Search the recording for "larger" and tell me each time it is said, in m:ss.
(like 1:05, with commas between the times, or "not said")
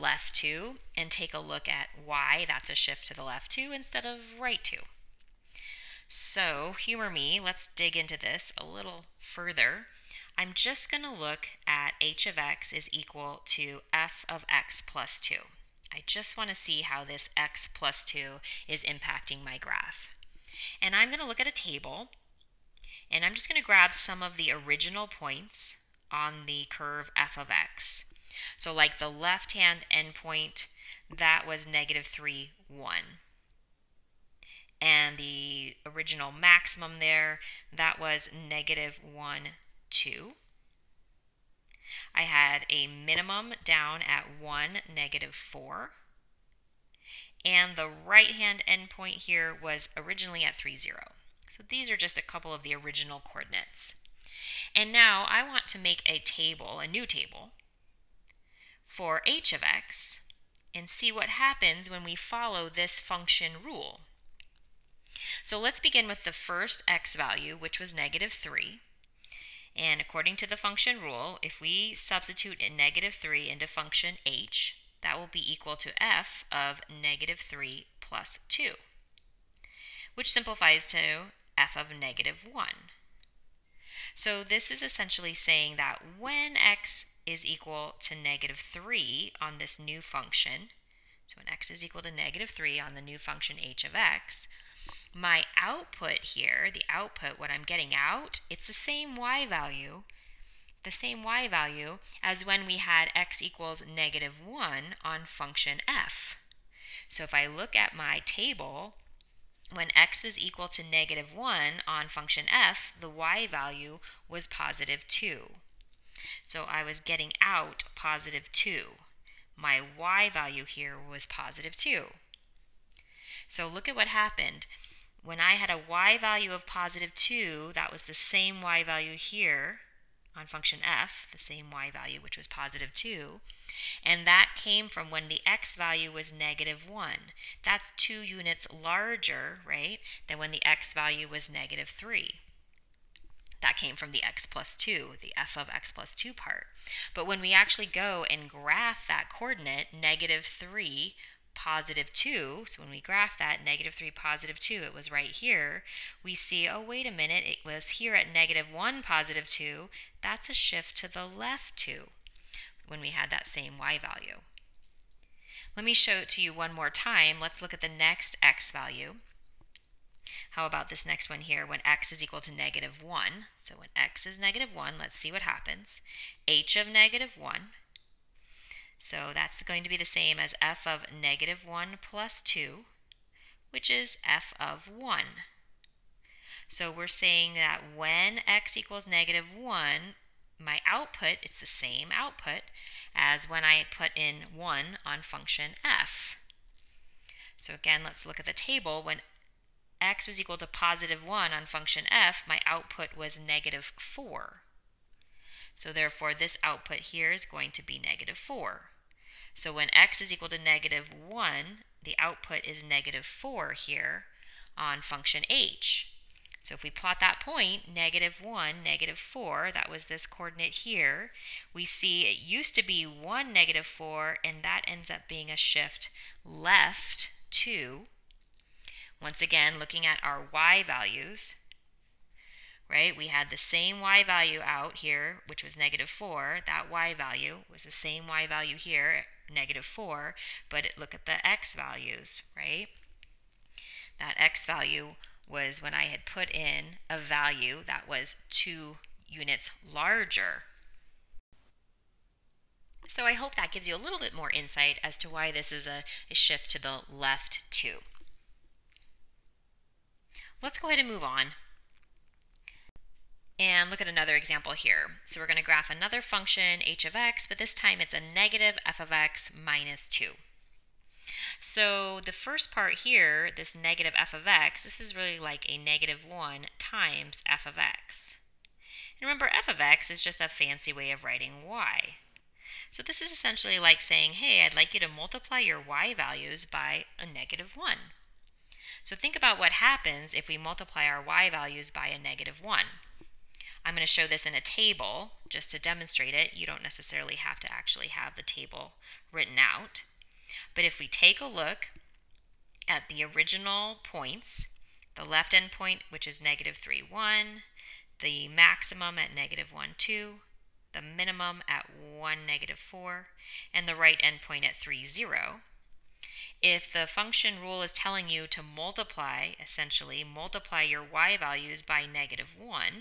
2:18, 4:09.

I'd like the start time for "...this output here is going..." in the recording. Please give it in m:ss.
3:26.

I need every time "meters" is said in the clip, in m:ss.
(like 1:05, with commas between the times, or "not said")
not said.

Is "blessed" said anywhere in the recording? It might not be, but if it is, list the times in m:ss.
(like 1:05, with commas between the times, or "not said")
not said.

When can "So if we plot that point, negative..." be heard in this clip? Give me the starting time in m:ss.
3:36.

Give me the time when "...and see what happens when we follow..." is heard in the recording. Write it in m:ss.
1:00.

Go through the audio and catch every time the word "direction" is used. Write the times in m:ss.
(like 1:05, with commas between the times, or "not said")
not said.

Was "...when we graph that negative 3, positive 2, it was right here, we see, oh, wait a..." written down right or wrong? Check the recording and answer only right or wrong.
right.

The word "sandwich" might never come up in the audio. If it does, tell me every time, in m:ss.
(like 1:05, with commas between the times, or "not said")
not said.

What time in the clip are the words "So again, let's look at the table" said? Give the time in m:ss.
3:17.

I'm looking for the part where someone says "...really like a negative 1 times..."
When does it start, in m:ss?
4:35.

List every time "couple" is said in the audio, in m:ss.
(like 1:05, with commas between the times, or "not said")
0:52.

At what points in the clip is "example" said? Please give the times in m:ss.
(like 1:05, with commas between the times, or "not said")
4:24.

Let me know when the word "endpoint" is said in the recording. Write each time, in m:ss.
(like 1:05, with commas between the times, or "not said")
0:29, 0:48, 5:05, 5:14.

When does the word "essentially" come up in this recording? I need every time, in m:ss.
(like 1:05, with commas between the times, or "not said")
1:24, 4:43, 5:19.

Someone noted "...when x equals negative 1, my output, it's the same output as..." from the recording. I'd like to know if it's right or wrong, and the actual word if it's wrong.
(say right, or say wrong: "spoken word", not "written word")
right.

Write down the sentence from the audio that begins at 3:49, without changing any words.
Once again, looking at our y values, right?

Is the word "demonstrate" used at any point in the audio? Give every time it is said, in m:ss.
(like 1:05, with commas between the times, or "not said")
4:55.